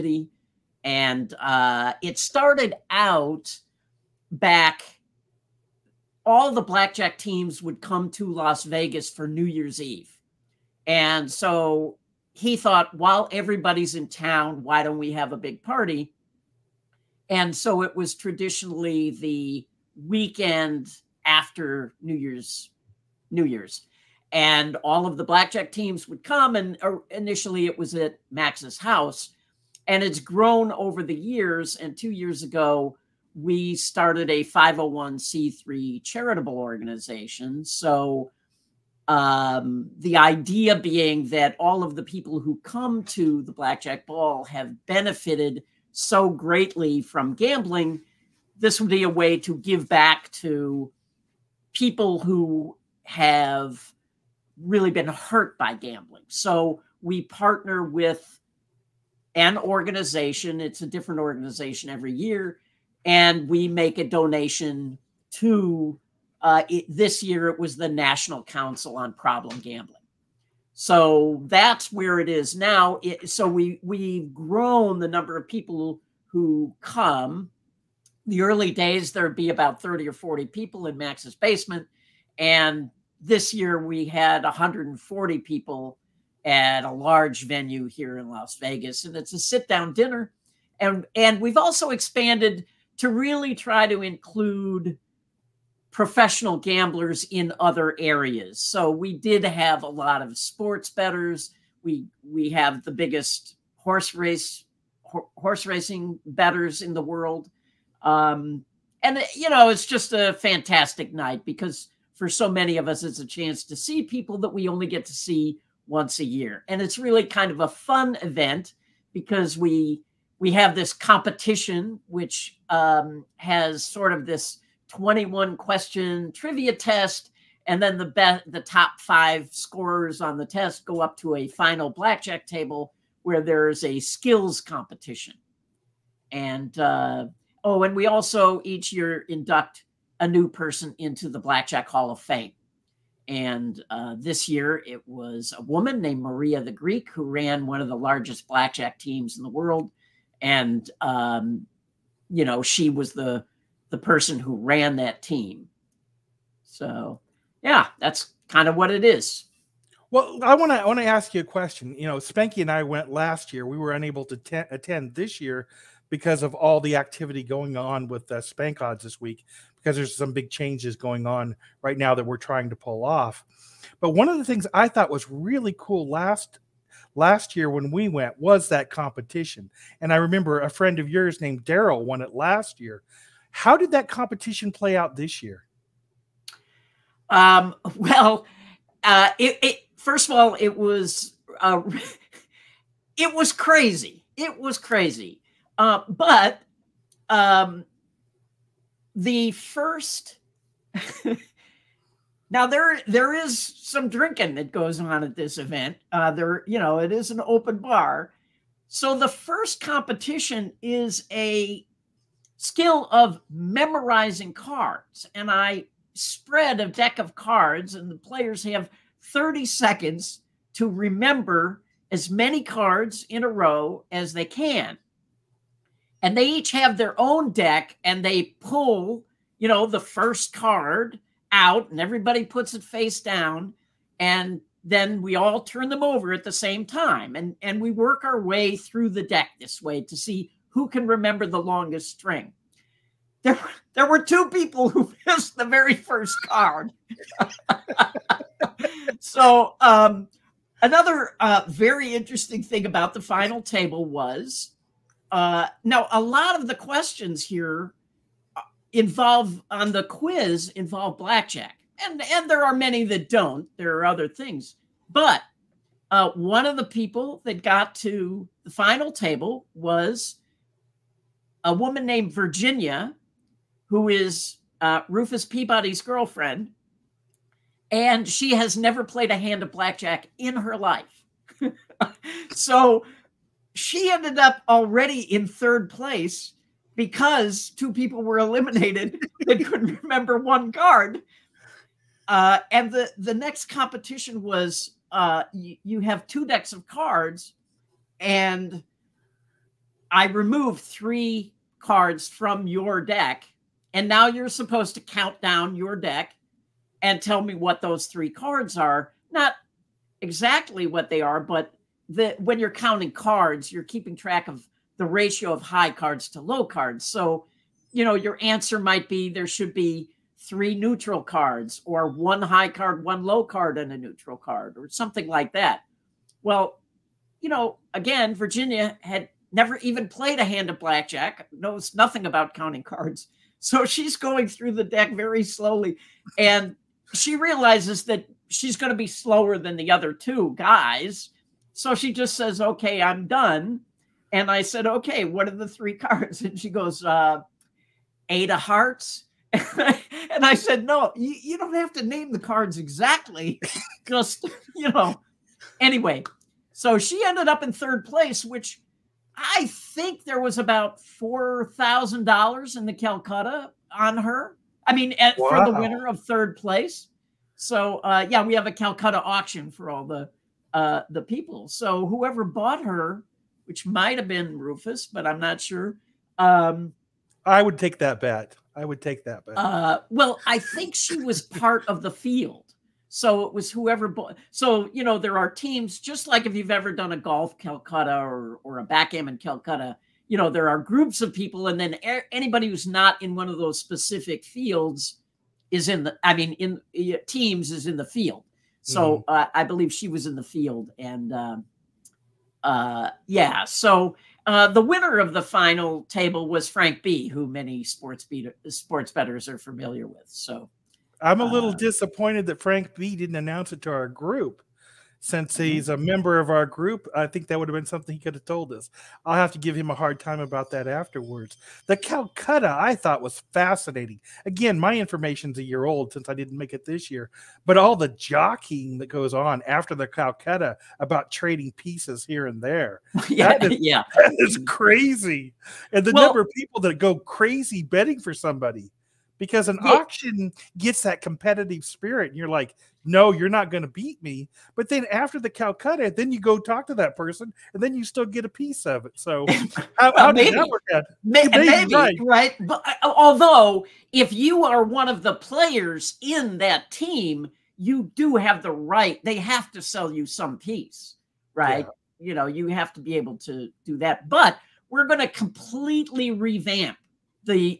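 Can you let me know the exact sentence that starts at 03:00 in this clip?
And I remember a friend of yours named Daryl won it last year.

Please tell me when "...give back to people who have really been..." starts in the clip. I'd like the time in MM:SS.
00:49.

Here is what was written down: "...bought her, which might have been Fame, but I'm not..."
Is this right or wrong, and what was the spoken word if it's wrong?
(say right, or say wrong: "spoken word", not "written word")
wrong: "Rufus", not "Fame".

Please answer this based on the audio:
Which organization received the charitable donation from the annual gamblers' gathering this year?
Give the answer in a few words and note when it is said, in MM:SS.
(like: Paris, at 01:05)
National Council on Problem Gambling, at 01:07.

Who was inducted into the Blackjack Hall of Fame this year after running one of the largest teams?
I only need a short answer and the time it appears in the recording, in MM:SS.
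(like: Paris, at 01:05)
Maria the Greek, at 02:26.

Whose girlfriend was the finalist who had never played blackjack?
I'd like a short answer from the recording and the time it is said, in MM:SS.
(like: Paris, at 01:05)
Rufus Peabody, at 04:35.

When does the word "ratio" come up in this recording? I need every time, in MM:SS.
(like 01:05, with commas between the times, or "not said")
05:15.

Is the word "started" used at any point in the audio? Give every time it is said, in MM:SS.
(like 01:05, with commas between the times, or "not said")
00:02, 00:33.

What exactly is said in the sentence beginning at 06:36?
I mean, in teams is in the field.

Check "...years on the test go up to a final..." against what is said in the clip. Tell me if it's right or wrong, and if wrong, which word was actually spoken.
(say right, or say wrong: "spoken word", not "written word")
wrong: "scorers", not "years".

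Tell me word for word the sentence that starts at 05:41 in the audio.
So she just says, okay, I'm done.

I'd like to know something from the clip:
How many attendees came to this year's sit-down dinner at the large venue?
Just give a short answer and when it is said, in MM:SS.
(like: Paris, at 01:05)
140, at 01:24.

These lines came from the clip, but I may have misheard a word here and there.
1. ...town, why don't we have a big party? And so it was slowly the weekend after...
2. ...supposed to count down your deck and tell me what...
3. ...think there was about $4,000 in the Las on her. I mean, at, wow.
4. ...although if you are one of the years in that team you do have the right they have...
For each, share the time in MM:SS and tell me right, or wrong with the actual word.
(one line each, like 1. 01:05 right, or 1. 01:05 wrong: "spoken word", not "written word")
1. 00:14 wrong: "traditionally", not "slowly"
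2. 05:04 right
3. 05:59 wrong: "Calcutta", not "Las"
4. 07:33 wrong: "players", not "years".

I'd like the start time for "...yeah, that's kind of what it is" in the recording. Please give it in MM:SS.
02:37.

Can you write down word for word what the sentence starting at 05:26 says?
Well, you know, again, Virginia had never even played a hand of blackjack, knows nothing about counting cards.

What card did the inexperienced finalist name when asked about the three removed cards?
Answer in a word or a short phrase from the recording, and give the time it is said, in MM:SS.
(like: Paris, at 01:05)
Eight of Hearts, at 05:48.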